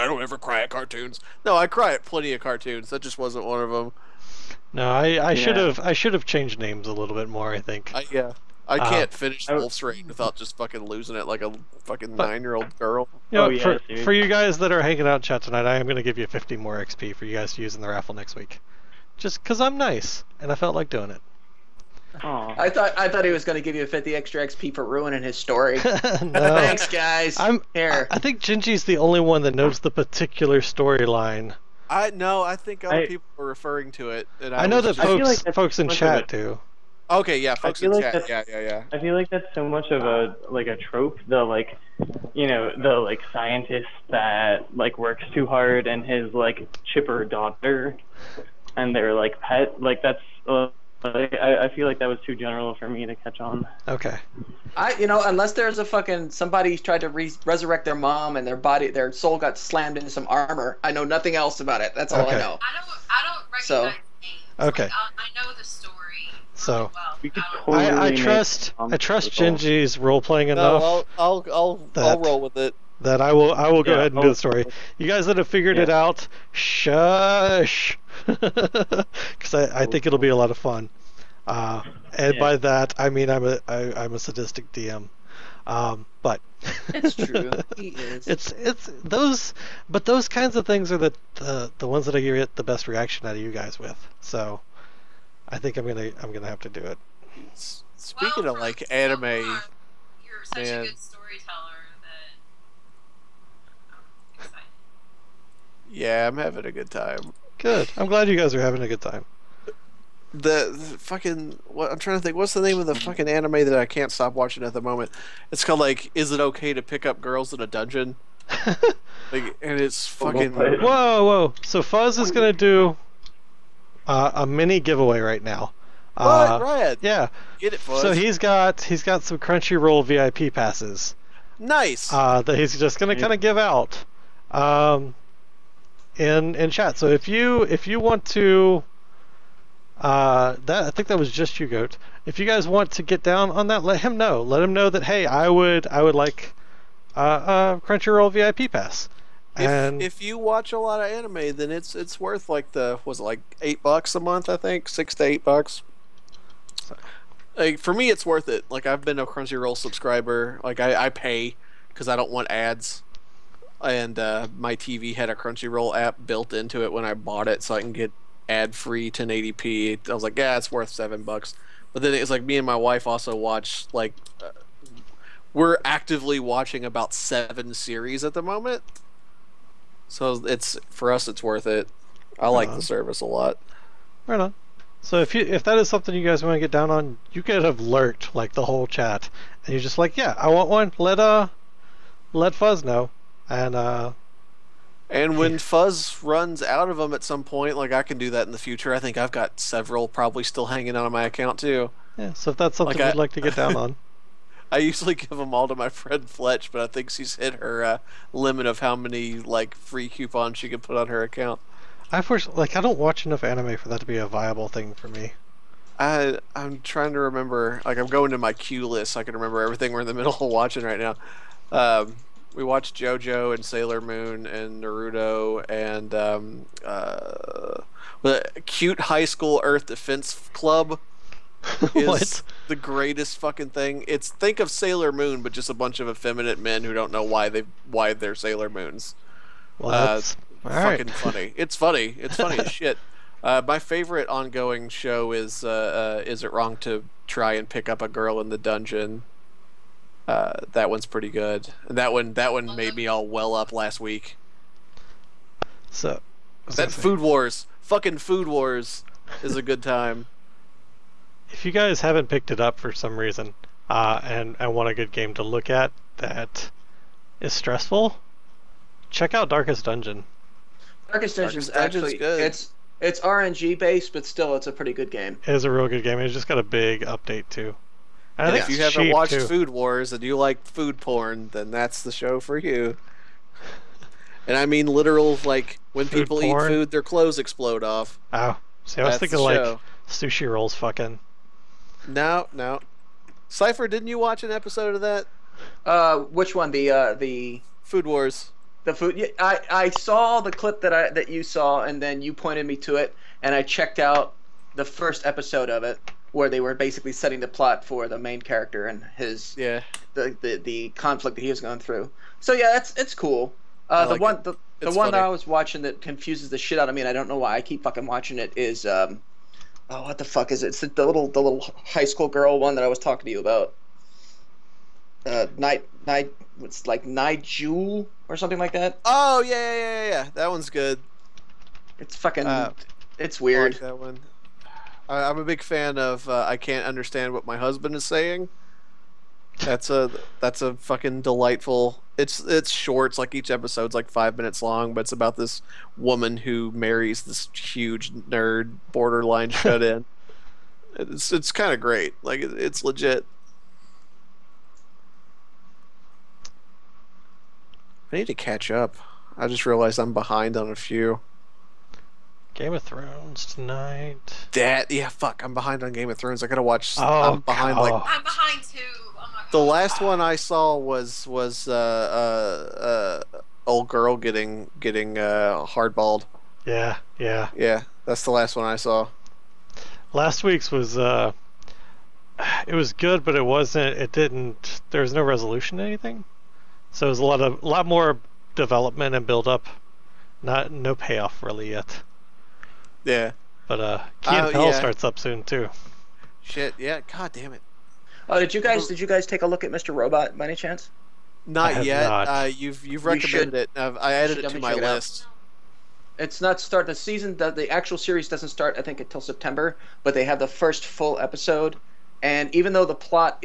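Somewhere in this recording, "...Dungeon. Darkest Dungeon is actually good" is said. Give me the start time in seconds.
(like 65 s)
269 s.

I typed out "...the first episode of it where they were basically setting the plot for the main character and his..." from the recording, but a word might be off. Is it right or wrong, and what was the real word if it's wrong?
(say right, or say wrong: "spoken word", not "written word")
right.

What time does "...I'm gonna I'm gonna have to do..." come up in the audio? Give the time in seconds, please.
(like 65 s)
95 s.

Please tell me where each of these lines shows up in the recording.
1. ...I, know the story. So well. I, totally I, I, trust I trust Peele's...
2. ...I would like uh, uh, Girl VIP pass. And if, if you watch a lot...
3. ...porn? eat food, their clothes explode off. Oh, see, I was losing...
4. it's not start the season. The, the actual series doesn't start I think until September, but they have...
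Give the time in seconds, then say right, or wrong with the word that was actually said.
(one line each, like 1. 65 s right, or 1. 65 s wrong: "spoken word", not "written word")
1. 64 s wrong: "Genji", not "Peele"
2. 145 s wrong: "Crunchyroll", not "Girl"
3. 286 s wrong: "thinking", not "losing"
4. 406 s right.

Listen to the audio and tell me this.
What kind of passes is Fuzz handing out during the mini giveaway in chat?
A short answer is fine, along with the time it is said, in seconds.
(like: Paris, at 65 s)
Crunchyroll VIP passes, at 129 s.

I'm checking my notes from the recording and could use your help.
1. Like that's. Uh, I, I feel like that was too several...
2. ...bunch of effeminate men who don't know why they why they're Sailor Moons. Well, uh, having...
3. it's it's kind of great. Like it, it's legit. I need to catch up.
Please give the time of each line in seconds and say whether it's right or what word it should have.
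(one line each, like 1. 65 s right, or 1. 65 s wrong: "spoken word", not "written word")
1. 49 s wrong: "general", not "several"
2. 235 s wrong: "fucking", not "having"
3. 350 s right.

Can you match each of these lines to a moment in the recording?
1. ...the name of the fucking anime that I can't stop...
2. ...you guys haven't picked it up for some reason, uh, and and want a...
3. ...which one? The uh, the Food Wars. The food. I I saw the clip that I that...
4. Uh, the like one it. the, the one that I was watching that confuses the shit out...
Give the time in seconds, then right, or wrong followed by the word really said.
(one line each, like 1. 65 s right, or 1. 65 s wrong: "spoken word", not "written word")
1. 112 s right
2. 261 s right
3. 296 s right
4. 313 s right.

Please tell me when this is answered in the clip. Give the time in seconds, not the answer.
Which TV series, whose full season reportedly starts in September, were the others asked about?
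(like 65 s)
399 s.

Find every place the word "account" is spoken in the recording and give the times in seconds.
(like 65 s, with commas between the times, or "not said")
201 s, 211 s.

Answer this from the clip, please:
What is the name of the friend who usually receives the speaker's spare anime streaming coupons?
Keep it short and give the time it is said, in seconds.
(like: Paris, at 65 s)
Fletch, at 206 s.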